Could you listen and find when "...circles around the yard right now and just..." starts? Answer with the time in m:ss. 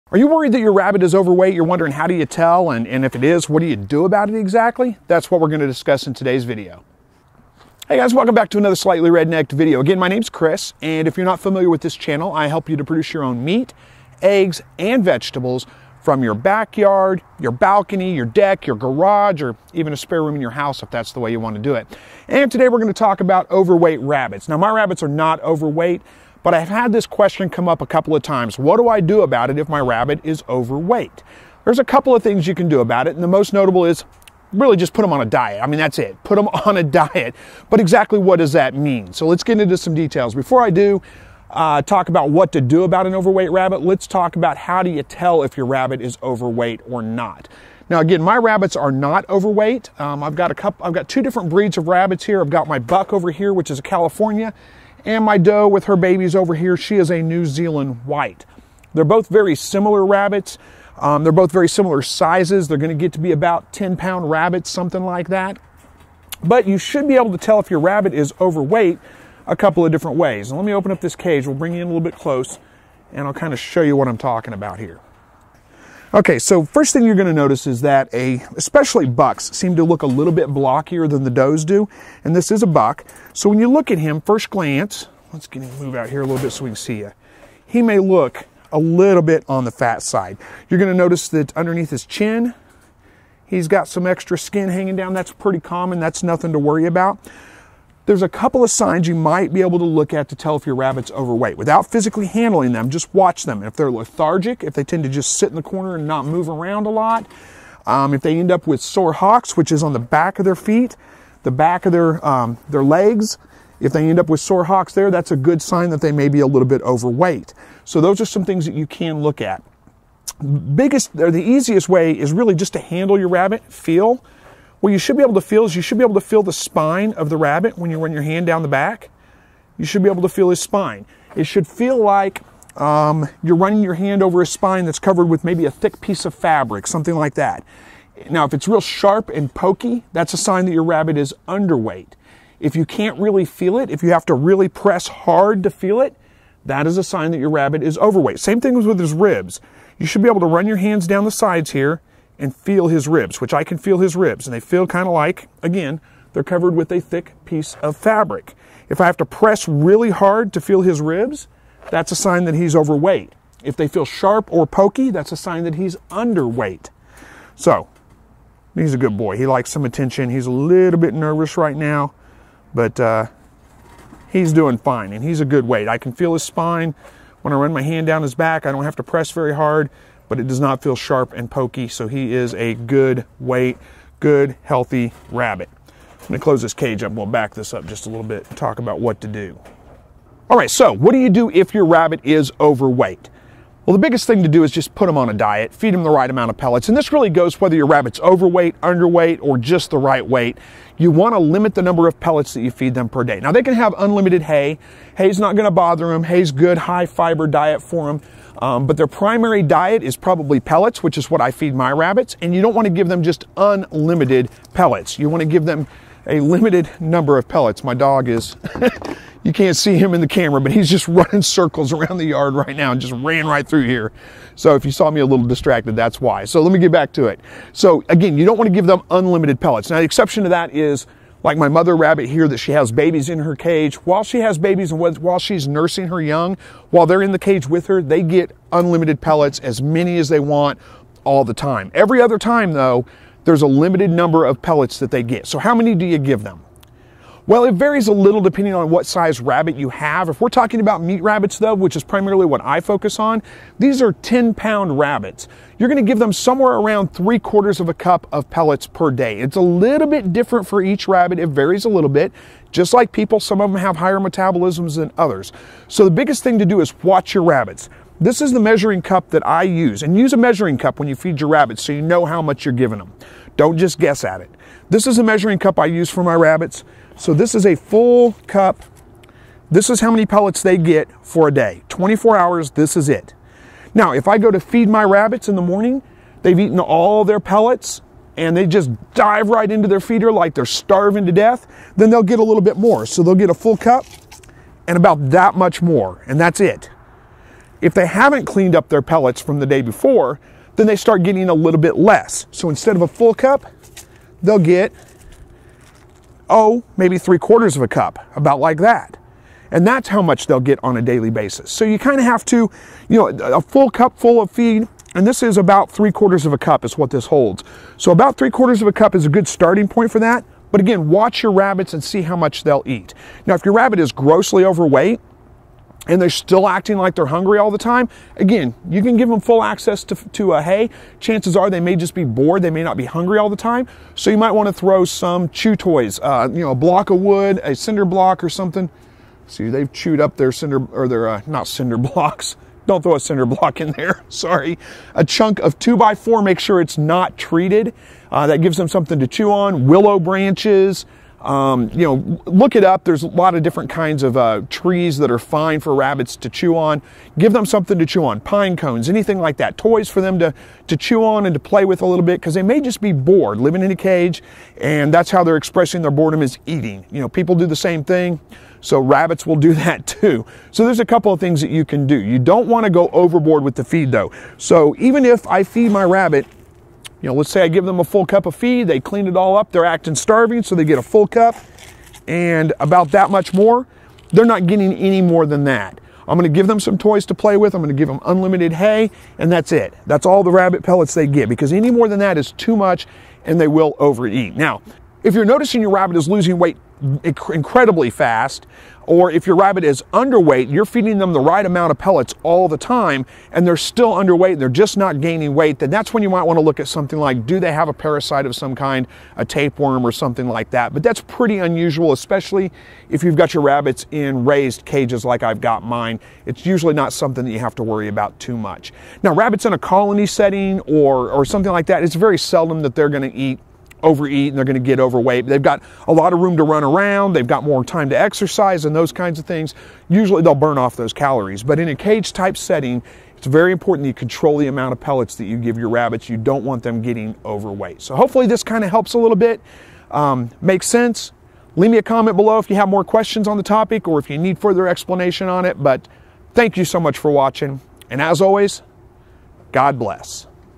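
3:41.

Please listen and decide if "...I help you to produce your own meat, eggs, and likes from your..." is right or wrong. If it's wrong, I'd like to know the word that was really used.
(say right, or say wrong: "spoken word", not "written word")
wrong: "vegetables", not "likes".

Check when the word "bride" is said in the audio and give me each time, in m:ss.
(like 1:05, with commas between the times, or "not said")
not said.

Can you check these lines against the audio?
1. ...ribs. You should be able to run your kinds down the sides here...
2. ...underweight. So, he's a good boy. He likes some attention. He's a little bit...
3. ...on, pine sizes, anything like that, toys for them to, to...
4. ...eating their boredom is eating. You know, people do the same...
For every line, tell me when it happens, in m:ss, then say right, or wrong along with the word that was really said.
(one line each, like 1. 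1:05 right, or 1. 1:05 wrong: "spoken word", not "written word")
1. 2:29 wrong: "hands", not "kinds"
2. 2:46 right
3. 5:58 wrong: "cones", not "sizes"
4. 6:05 wrong: "expressing", not "eating".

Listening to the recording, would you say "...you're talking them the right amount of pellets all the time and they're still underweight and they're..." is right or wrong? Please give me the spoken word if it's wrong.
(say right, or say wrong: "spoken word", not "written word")
wrong: "feeding", not "talking".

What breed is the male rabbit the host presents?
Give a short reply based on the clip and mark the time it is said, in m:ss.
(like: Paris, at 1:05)
California, at 0:53.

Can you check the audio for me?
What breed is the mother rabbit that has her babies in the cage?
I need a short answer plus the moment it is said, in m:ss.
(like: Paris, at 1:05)
New Zealand white, at 0:57.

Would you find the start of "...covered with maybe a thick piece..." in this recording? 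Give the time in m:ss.
2:14.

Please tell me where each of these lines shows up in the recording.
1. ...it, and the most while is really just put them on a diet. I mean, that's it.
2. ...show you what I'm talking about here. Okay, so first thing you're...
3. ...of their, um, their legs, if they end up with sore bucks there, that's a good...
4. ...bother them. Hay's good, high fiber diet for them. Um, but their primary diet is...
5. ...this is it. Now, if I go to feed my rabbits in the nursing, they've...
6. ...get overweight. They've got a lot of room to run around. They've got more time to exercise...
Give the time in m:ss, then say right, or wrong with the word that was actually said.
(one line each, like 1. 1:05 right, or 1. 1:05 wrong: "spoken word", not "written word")
1. 0:33 wrong: "notable", not "while"
2. 1:13 right
3. 1:51 wrong: "hocks", not "bucks"
4. 3:25 right
5. 4:42 wrong: "morning", not "nursing"
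6. 7:04 right.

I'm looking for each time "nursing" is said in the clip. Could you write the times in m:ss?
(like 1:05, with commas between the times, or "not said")
3:55.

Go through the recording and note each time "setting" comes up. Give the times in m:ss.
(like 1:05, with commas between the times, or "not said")
7:00, 7:12.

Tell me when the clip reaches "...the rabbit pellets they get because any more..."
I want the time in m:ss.
6:30.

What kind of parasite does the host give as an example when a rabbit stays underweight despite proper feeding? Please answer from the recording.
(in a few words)
Tapeworm.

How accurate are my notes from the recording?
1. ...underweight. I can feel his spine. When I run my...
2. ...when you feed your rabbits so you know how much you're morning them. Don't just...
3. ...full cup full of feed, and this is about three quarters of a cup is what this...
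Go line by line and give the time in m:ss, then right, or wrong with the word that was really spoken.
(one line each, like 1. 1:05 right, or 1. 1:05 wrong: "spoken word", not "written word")
1. 2:55 wrong: "weight", not "underweight"
2. 4:30 wrong: "giving", not "morning"
3. 5:13 right.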